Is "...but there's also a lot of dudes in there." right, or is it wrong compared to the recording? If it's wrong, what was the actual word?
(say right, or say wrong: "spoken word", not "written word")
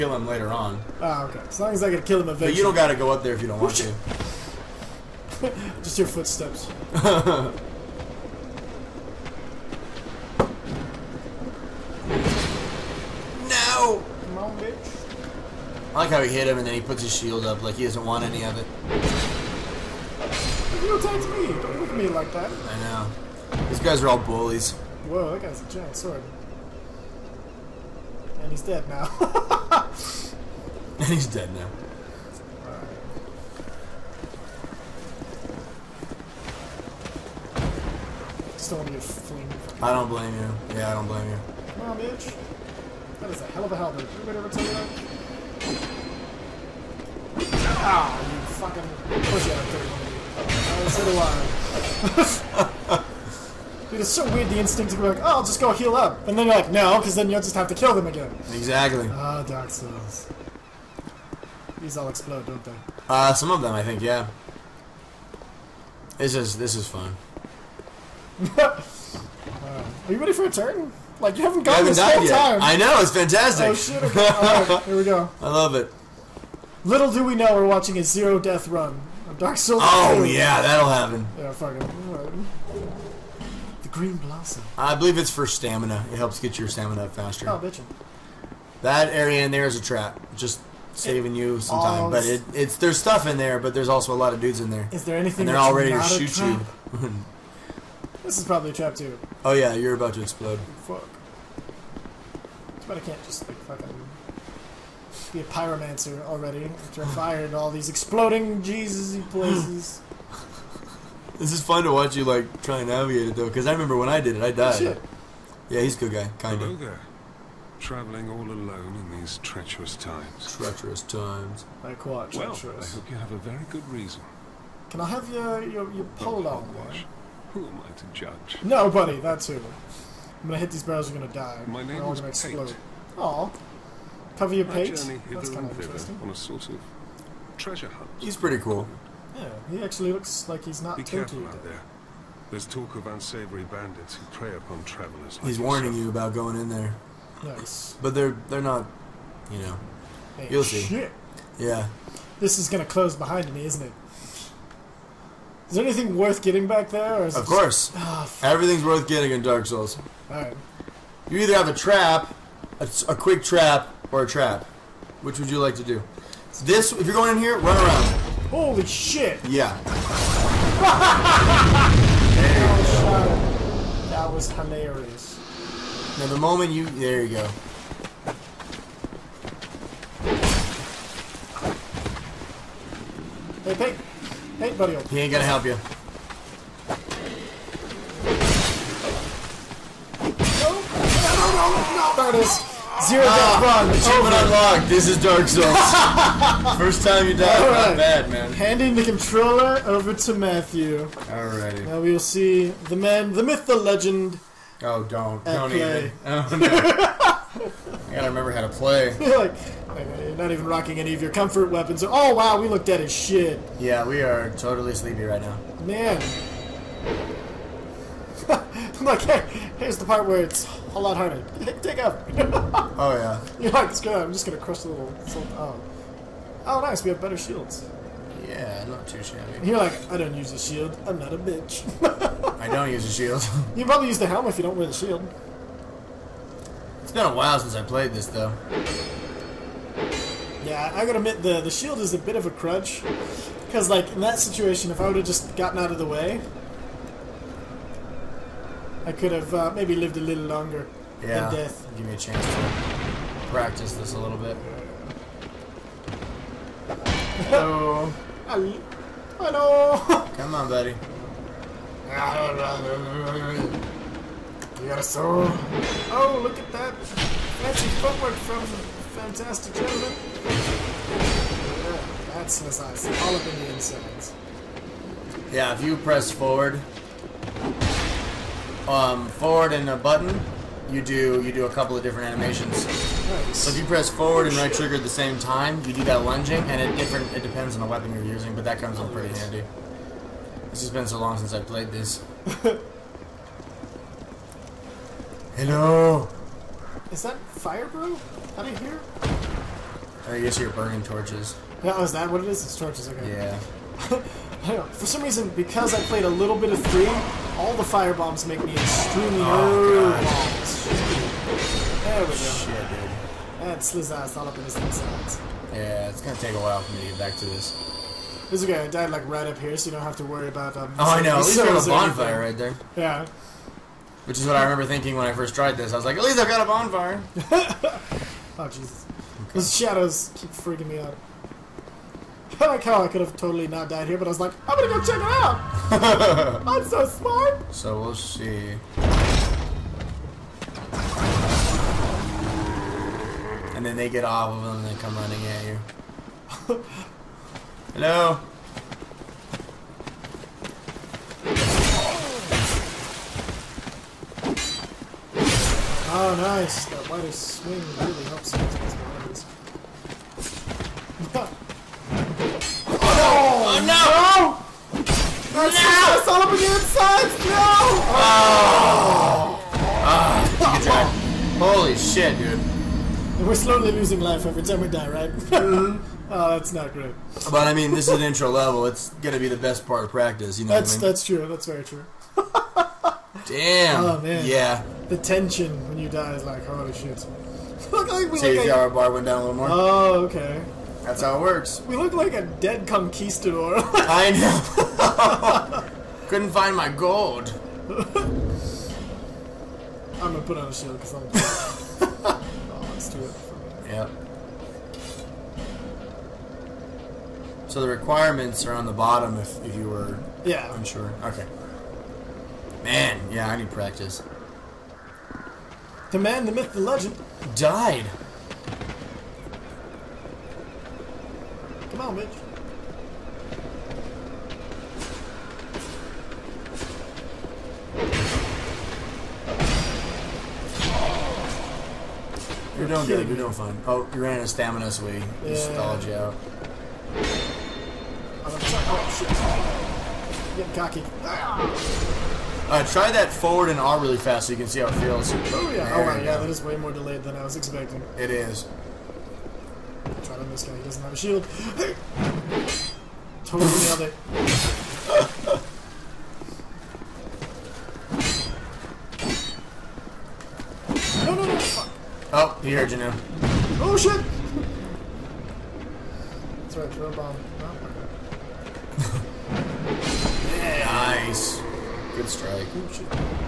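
right.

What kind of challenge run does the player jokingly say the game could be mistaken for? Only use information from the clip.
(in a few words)
Zero death run.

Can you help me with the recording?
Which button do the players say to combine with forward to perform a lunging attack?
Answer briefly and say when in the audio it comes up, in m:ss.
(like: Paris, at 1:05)
Right trigger, at 4:44.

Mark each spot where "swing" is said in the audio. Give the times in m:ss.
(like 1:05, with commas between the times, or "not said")
5:57, 7:14.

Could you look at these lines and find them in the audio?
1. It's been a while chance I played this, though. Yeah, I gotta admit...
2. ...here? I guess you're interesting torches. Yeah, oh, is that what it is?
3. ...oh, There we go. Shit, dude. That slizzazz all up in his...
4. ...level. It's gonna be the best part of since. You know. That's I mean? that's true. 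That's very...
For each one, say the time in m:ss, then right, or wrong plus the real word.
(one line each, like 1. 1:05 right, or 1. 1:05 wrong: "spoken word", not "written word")
1. 3:57 wrong: "since", not "chance"
2. 4:58 wrong: "burning", not "interesting"
3. 5:09 right
4. 6:18 wrong: "practice", not "since".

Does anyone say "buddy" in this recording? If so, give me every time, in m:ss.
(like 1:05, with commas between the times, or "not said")
3:04, 4:20.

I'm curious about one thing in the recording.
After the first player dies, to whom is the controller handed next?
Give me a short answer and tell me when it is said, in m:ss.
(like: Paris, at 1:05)
Matthew, at 3:20.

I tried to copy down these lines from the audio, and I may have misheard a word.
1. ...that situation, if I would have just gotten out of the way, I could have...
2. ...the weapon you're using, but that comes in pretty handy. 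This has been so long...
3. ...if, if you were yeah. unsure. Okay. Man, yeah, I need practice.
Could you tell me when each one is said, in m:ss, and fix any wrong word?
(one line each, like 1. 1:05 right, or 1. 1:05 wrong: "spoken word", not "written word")
1. 4:04 right
2. 4:47 right
3. 6:49 right.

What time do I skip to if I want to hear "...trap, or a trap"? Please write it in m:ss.
2:43.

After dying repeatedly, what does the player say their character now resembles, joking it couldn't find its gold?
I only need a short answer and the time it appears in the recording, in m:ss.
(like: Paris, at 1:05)
A dead conquistador, at 6:32.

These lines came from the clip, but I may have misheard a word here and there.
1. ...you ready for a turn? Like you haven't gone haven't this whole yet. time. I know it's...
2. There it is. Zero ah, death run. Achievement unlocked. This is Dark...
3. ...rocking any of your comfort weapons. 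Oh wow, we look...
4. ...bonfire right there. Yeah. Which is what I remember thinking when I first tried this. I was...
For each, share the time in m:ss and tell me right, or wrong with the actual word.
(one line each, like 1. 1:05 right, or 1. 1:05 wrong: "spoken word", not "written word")
1. 1:10 right
2. 3:12 right
3. 3:30 right
4. 5:21 right.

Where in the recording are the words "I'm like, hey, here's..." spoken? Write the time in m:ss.
3:38.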